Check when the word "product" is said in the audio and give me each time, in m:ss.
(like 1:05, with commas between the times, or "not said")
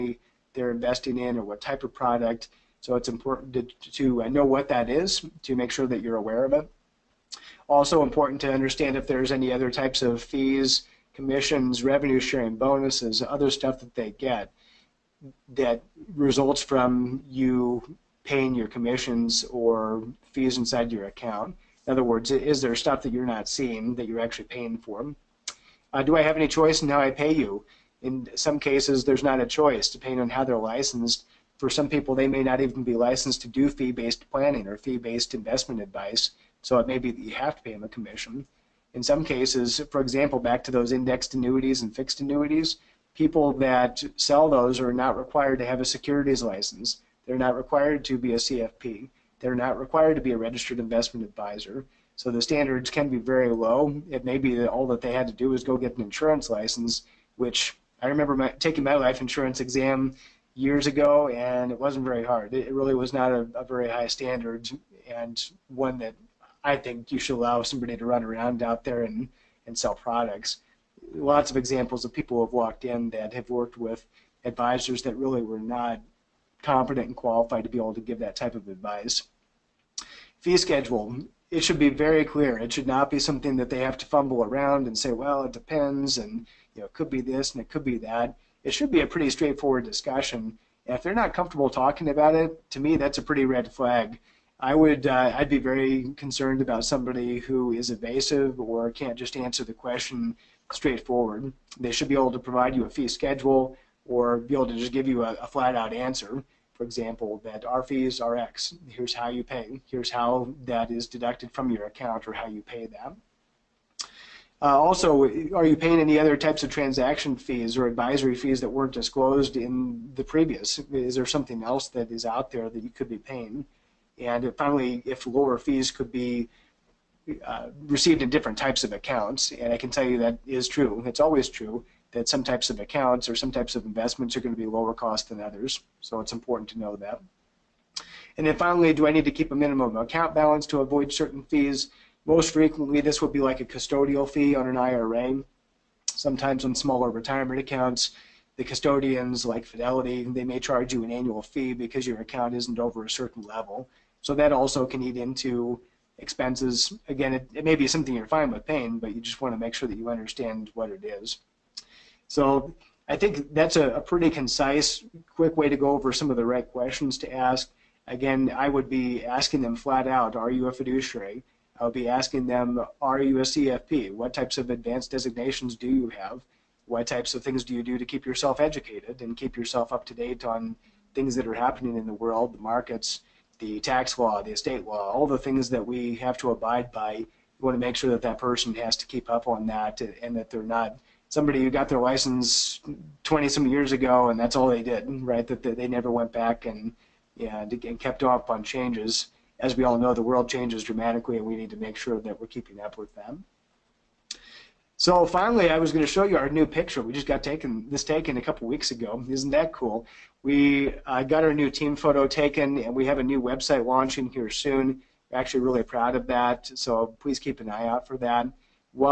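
0:01, 1:09.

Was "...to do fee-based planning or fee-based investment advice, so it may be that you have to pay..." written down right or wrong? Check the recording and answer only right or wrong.
right.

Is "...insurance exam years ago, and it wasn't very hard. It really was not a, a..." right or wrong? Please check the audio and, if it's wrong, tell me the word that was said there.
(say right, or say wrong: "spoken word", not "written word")
right.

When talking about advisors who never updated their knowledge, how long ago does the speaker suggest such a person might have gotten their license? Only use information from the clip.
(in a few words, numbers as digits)
20 some years ago.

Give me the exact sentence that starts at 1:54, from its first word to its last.
Uh, also, are you paying any other types of transaction fees or advisory fees that weren't disclosed in the previous?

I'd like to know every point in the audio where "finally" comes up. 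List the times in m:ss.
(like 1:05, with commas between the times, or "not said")
2:04, 2:18, 3:25.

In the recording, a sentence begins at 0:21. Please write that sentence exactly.
In other words, is there stuff that you're not seeing that you're actually paying for?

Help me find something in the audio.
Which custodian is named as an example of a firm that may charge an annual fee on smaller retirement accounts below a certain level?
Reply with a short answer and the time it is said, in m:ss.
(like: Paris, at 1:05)
Fidelity, at 2:29.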